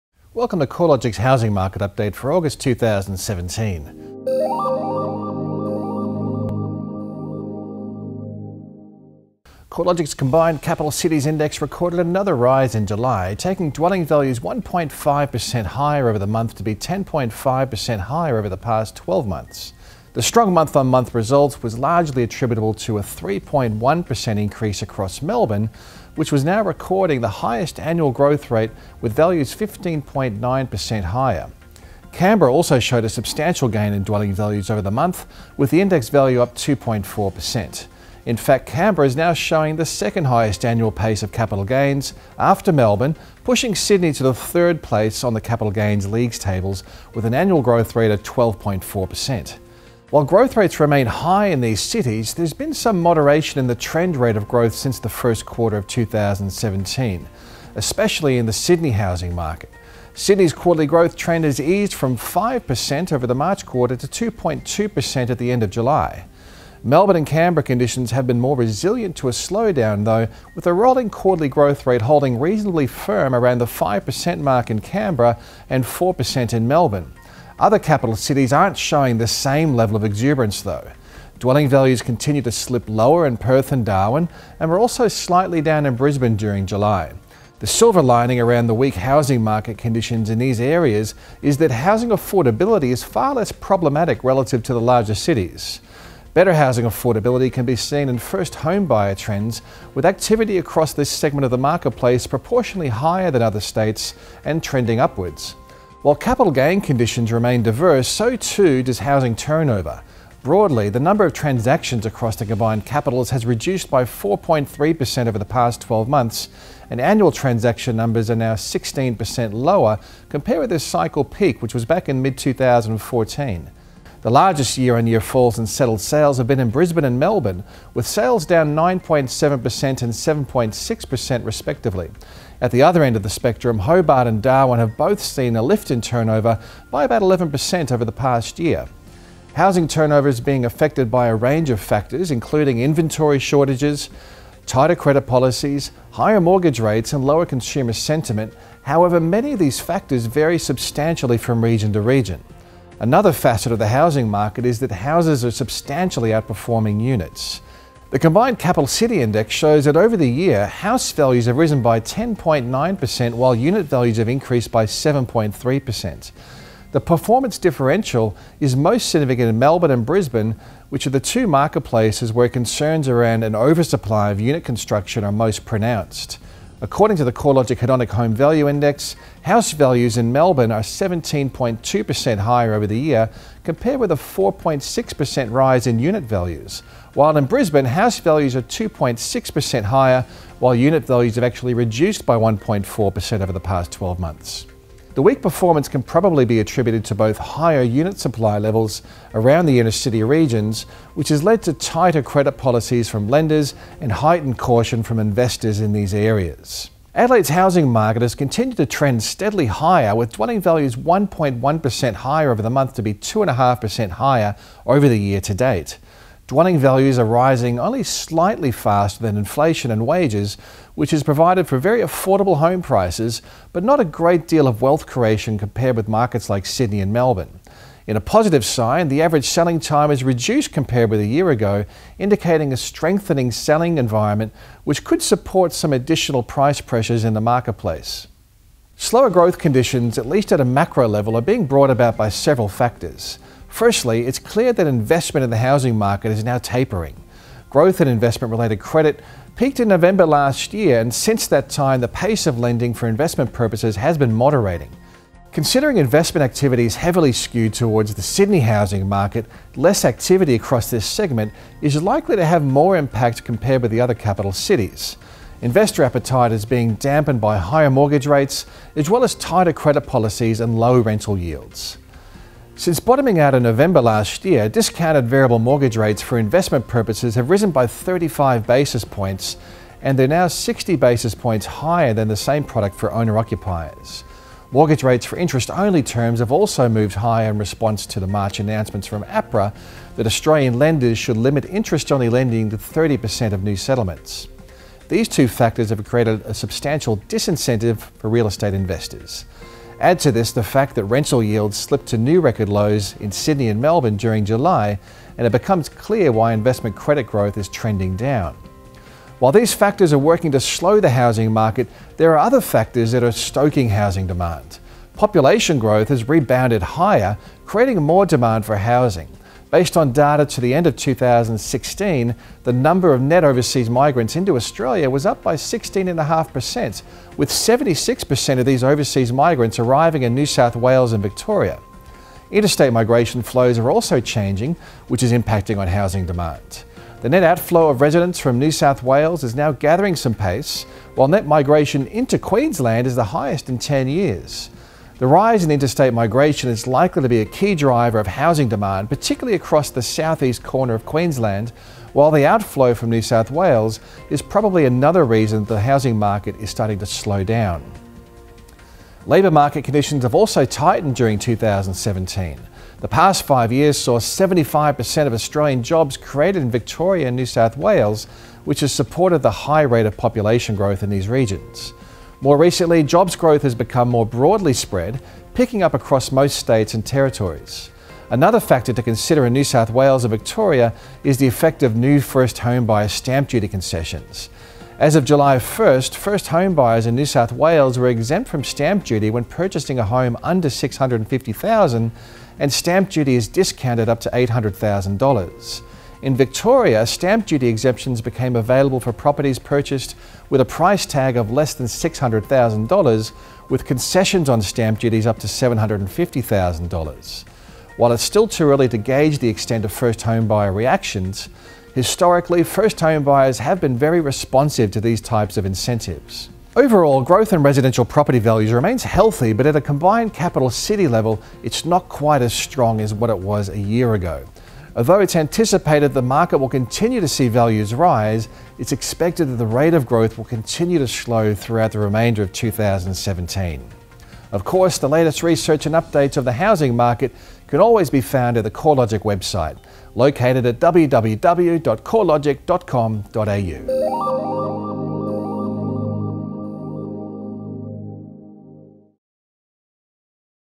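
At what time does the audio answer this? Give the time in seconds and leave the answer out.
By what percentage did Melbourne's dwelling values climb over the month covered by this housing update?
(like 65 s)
23 s.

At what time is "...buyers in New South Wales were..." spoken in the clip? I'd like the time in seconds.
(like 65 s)
386 s.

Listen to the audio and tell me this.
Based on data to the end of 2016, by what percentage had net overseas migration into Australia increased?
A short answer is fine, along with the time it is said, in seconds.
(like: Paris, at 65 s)
16.5%, at 325 s.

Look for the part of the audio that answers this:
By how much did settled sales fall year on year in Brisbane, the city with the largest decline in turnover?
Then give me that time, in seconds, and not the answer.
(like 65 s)
128 s.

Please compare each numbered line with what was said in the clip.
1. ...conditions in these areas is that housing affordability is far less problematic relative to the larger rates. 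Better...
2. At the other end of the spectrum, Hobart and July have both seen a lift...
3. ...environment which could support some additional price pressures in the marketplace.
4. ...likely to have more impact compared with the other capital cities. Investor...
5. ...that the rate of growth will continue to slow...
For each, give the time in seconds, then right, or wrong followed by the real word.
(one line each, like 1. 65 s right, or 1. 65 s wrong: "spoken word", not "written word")
1. 89 s wrong: "cities", not "rates"
2. 132 s wrong: "Darwin", not "July"
3. 233 s right
4. 262 s right
5. 429 s right.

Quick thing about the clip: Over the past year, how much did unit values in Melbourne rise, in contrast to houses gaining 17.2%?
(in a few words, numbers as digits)
4.6%.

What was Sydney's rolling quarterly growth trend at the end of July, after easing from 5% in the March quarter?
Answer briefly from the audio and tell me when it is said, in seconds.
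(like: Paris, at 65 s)
2.2%, at 64 s.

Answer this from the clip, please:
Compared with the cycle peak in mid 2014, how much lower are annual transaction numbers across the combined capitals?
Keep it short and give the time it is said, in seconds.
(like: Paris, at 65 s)
16%, at 118 s.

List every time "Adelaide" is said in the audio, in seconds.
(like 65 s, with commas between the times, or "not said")
207 s.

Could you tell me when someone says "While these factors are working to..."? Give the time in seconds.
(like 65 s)
309 s.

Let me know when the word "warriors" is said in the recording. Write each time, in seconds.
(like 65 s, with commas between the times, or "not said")
not said.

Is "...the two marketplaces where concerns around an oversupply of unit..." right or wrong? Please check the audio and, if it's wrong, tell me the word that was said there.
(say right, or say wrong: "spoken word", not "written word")
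right.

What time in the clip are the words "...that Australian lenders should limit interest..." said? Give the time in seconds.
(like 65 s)
290 s.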